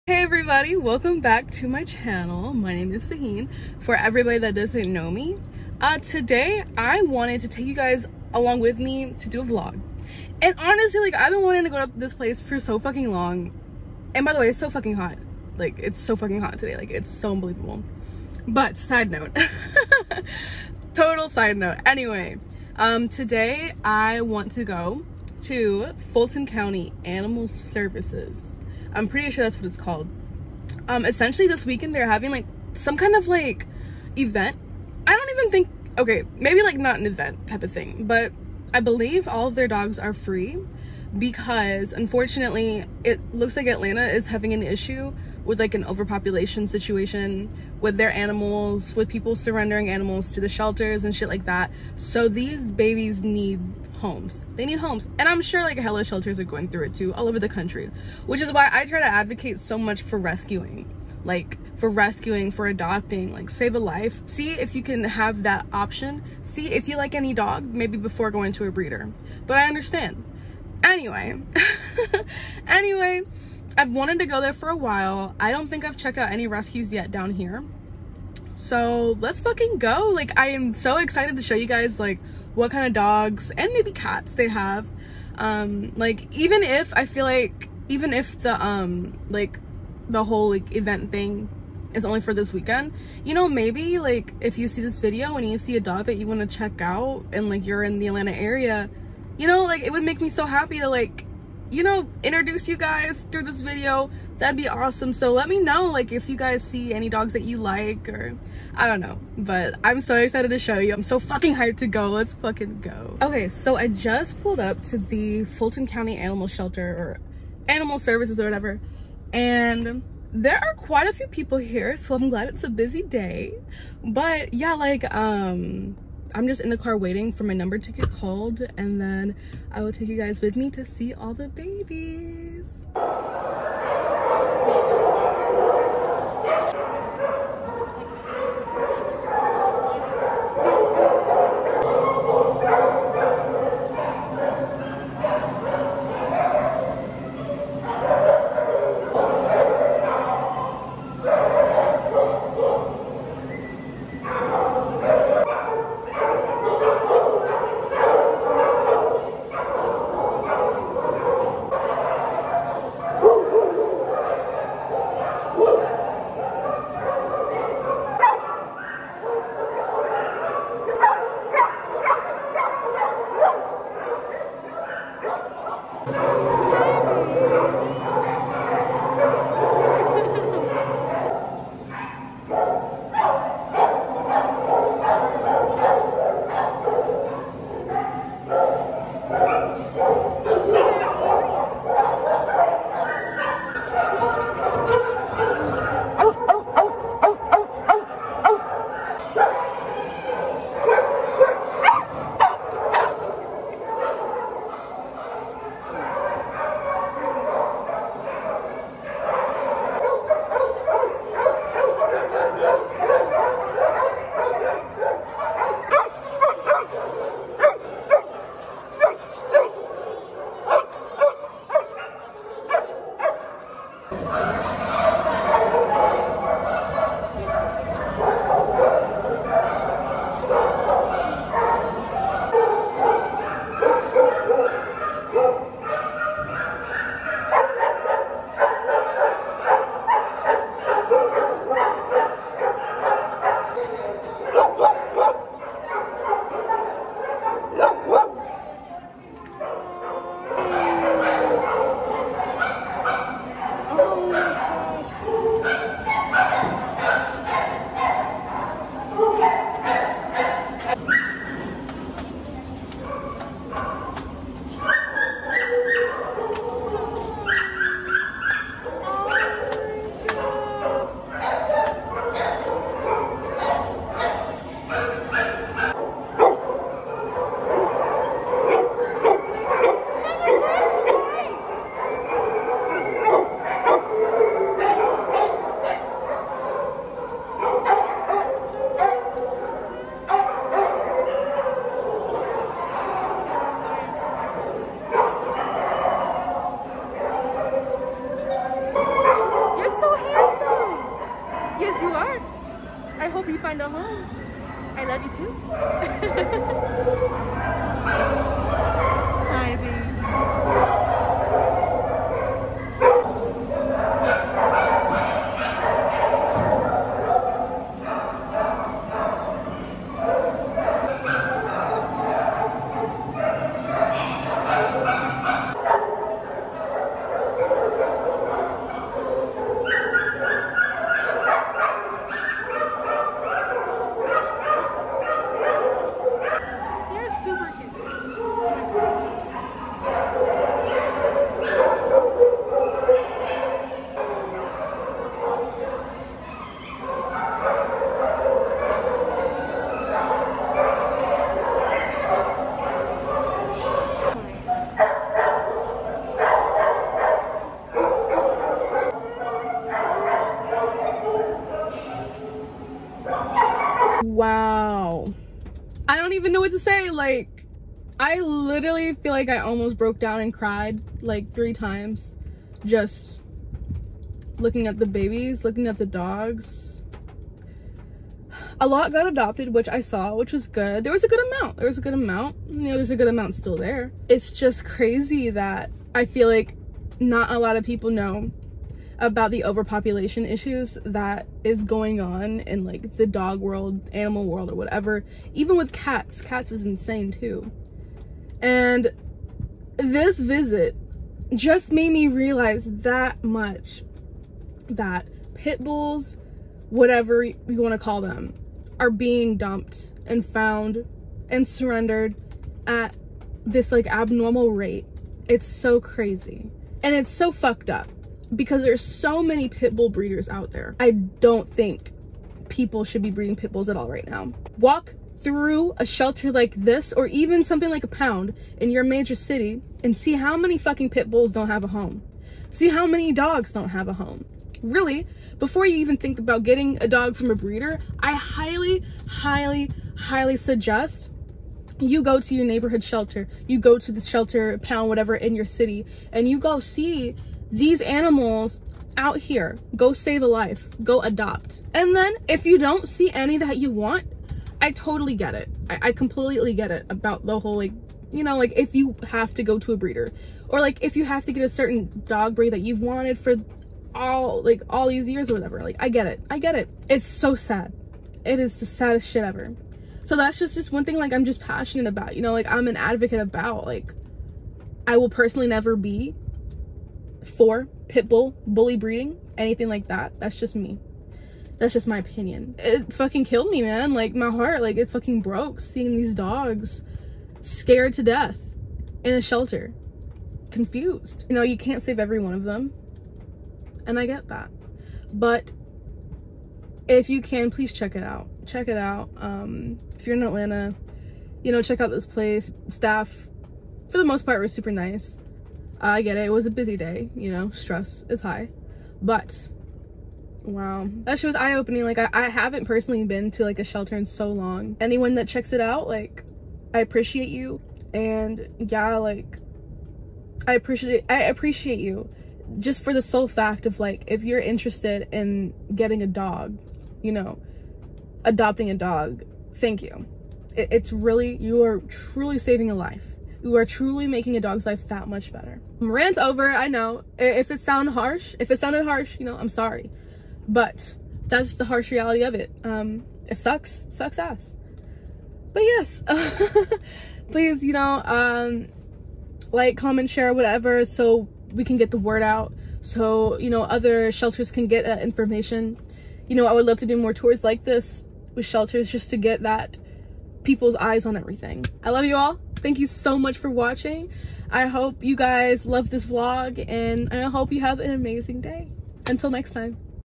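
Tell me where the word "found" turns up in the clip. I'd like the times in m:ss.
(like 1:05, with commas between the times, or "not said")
6:50.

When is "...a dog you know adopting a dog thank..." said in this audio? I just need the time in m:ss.
8:46.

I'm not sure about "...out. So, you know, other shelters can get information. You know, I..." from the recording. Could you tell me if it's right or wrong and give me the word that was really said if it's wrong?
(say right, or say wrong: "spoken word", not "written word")
right.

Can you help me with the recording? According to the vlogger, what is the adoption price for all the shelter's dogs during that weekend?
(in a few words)
free.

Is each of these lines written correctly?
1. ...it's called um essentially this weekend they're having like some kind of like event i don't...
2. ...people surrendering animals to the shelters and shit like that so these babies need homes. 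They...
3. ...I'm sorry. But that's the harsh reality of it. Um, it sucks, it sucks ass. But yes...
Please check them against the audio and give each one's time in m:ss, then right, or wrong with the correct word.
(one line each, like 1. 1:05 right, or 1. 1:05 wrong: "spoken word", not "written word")
1. 0:29 right
2. 0:49 right
3. 8:59 right.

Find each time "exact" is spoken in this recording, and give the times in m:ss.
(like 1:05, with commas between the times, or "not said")
not said.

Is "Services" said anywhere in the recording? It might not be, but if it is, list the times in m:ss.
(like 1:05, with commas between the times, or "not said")
0:27, 1:57.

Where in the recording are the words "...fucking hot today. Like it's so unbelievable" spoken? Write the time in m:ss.
0:16.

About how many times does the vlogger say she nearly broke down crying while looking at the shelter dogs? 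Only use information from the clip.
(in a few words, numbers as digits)
3.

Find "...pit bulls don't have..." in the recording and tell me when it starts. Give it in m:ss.
7:11.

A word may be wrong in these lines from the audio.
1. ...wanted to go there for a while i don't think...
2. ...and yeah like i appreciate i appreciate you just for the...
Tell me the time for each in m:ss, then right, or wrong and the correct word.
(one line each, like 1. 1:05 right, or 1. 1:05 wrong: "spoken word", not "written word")
1. 1:13 right
2. 8:38 right.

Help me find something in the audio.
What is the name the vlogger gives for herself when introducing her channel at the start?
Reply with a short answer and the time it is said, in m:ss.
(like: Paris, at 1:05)
Sihene, at 0:03.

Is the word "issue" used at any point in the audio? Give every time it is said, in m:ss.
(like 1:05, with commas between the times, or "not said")
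0:44, 6:30.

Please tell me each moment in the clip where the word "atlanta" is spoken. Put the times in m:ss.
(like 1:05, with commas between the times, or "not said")
0:43, 1:38, 8:20.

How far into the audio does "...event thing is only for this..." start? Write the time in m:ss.
1:30.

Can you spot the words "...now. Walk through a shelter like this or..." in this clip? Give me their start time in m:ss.
7:04.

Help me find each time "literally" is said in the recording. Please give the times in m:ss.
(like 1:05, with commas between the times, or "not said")
6:08.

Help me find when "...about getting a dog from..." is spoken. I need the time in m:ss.
7:16.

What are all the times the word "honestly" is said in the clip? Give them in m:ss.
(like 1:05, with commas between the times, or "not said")
0:10.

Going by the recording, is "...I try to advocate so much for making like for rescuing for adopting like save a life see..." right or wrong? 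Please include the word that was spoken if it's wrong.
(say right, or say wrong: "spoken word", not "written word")
wrong: "rescuing", not "making".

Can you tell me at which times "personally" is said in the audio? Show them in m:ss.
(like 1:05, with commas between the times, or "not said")
7:55, 8:32.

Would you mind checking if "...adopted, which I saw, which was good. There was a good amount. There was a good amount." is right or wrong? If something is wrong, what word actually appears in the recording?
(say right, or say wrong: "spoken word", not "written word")
right.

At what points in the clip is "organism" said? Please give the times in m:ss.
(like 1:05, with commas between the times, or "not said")
not said.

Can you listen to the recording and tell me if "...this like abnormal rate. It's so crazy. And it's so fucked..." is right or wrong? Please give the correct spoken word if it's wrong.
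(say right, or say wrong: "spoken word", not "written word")
right.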